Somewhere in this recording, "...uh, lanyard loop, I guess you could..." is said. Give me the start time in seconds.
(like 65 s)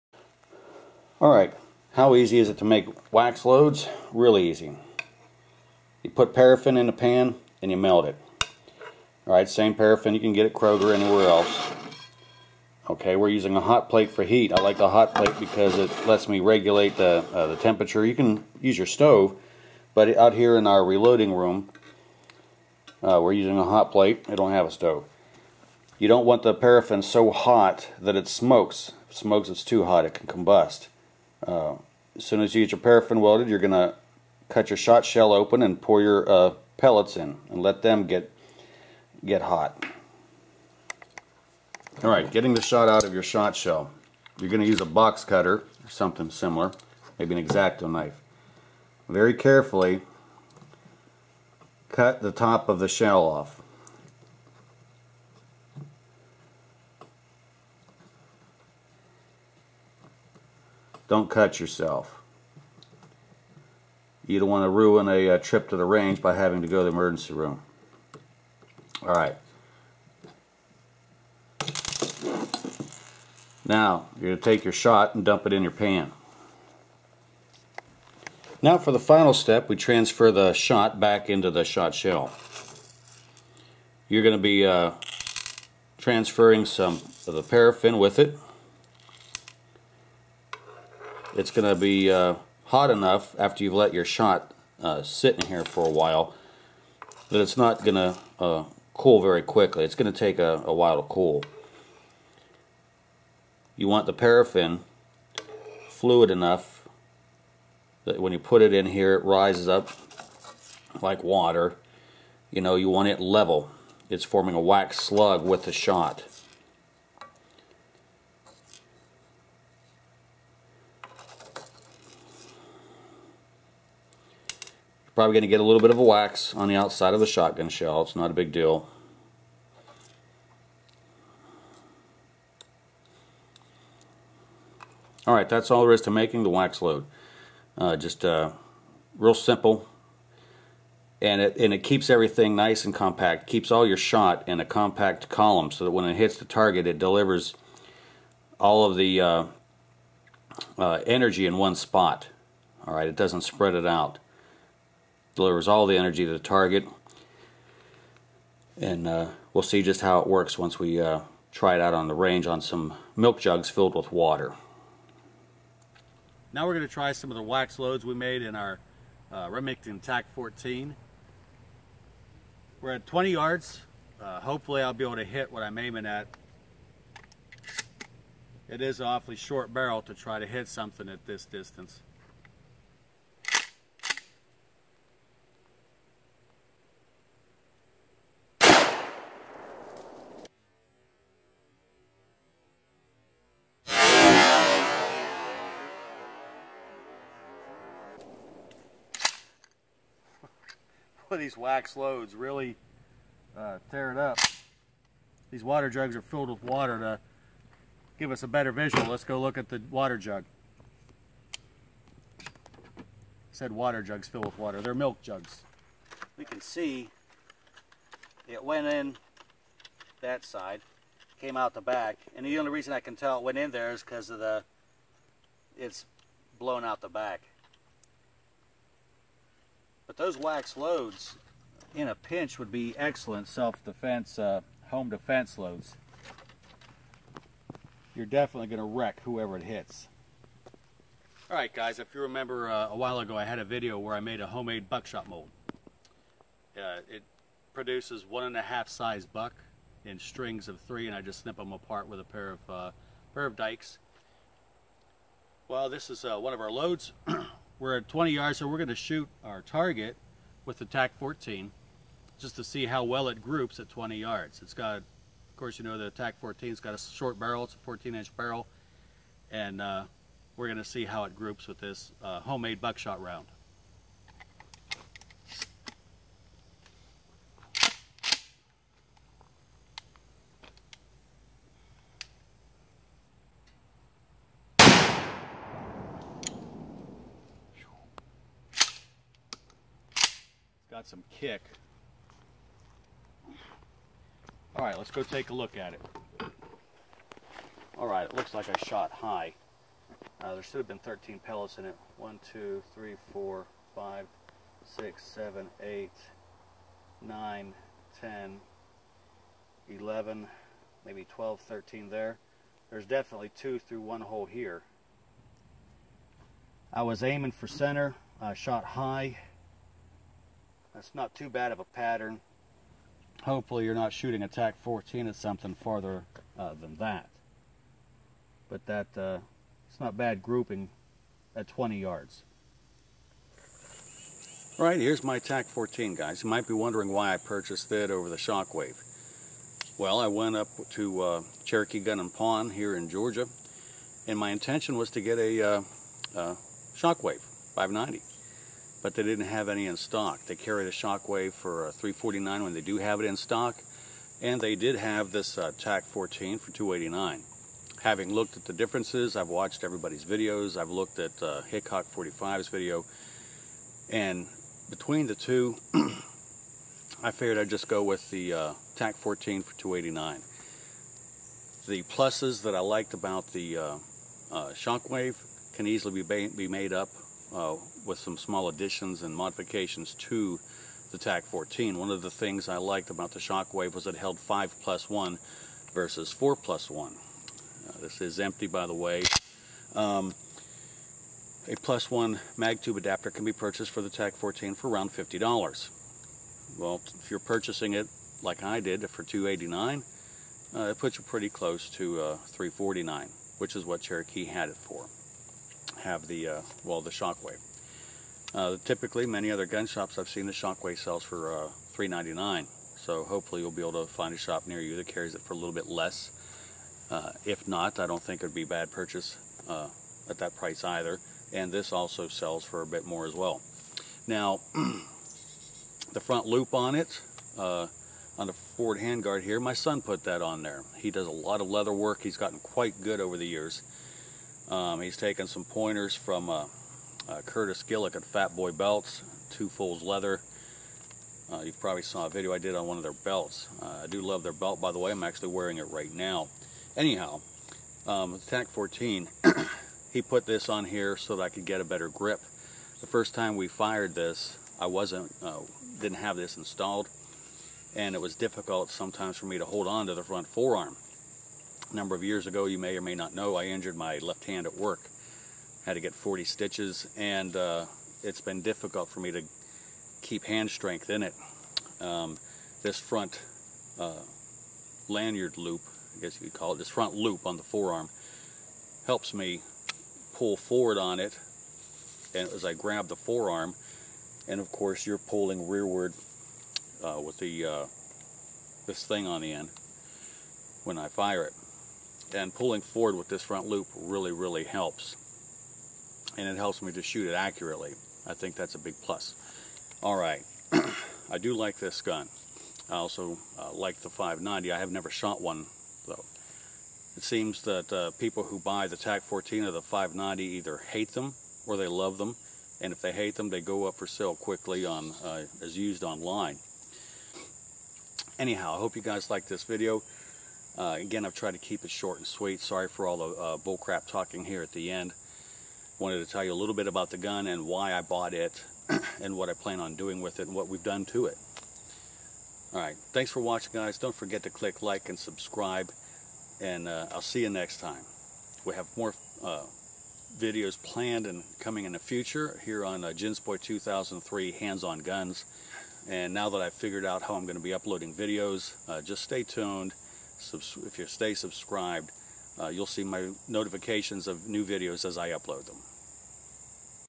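473 s.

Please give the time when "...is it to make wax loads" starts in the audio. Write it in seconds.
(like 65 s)
2 s.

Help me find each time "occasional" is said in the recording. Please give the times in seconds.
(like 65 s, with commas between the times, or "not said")
not said.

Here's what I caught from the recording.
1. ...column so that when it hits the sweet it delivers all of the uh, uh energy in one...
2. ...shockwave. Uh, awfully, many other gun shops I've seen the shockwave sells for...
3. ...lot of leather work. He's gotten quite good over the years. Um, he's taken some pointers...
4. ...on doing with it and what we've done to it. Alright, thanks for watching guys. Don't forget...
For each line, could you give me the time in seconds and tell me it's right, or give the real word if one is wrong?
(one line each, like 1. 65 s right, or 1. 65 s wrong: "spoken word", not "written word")
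1. 145 s wrong: "target", not "sweet"
2. 407 s wrong: "typically", not "awfully"
3. 431 s right
4. 529 s right.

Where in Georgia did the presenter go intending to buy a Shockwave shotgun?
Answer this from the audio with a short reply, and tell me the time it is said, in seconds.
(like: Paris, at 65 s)
Cherokee Gun and Pawn, at 341 s.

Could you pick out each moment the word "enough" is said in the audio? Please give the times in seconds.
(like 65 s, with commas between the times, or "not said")
92 s, 106 s.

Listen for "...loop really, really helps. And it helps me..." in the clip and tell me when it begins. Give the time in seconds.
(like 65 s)
493 s.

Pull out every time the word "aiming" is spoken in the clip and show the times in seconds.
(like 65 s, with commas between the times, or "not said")
175 s, 317 s.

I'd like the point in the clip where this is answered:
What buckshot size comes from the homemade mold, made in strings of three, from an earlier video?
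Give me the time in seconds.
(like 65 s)
248 s.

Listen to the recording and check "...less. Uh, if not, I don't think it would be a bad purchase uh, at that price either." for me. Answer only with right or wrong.
right.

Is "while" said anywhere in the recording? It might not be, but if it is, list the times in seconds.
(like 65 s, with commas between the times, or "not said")
95 s, 100 s, 242 s.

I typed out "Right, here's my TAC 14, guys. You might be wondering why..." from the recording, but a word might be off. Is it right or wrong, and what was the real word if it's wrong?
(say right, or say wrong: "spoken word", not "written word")
right.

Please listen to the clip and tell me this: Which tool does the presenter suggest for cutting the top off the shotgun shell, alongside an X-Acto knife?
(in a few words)
box cutter.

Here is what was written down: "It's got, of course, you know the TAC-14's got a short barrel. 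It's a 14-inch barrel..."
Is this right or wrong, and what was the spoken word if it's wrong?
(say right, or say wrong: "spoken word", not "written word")
right.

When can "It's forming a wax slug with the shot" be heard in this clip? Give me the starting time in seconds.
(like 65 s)
114 s.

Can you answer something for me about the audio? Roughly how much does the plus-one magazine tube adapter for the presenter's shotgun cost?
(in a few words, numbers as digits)
$50.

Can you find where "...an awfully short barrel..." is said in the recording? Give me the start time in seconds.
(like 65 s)
178 s.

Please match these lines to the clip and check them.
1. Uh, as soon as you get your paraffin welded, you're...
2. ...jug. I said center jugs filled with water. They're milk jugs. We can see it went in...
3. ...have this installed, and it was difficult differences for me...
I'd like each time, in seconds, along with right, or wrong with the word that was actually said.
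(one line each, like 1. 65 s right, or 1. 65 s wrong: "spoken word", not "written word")
1. 31 s right
2. 210 s wrong: "water", not "center"
3. 456 s wrong: "sometimes", not "differences".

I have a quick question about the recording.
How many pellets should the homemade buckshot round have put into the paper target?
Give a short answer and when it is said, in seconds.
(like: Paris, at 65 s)
13, at 300 s.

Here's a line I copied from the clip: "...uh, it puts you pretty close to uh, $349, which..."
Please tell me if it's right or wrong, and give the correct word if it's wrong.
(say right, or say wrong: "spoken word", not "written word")
right.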